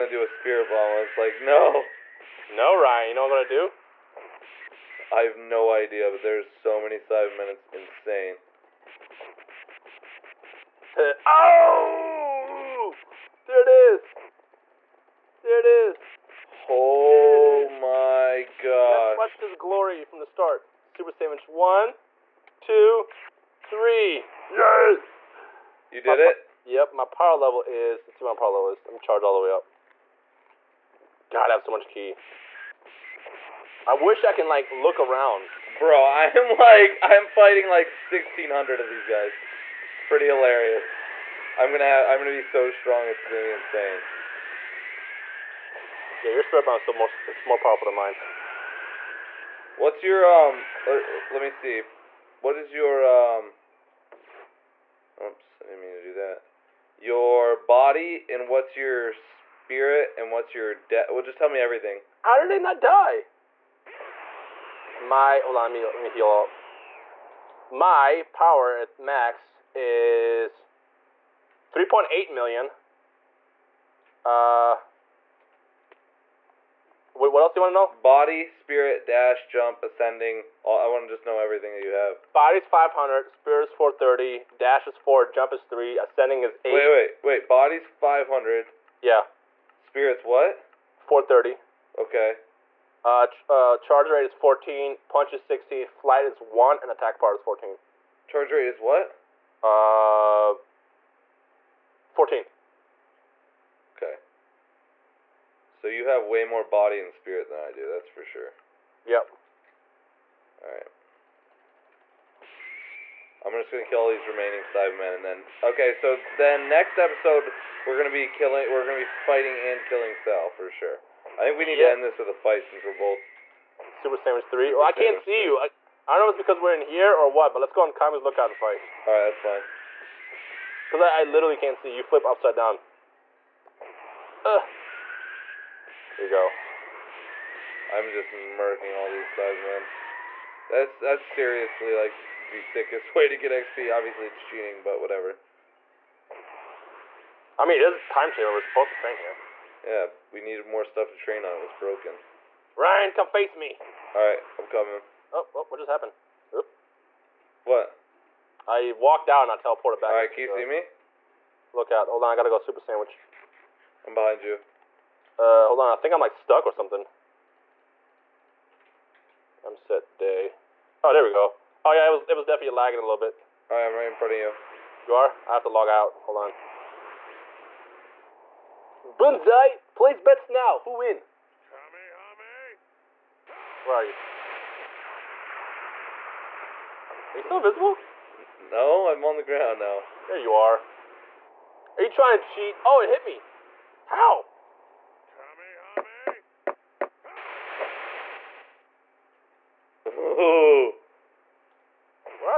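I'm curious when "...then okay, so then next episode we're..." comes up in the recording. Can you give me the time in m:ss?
1:55.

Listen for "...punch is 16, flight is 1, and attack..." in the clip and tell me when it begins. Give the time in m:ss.
1:35.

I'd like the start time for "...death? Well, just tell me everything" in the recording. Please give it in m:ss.
1:00.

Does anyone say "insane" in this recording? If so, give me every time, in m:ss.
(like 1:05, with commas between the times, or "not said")
0:07, 0:43.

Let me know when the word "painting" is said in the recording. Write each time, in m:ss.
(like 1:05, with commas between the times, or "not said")
not said.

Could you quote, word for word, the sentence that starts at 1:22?
Body's 500, spirit is 430, dash is 4, jump is 3, ascending is 8.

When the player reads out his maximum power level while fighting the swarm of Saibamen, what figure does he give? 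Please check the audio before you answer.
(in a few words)
3.8 million.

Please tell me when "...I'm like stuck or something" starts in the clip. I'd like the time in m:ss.
2:46.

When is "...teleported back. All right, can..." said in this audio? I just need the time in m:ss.
2:39.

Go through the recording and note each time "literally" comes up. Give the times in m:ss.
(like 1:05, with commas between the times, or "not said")
2:11.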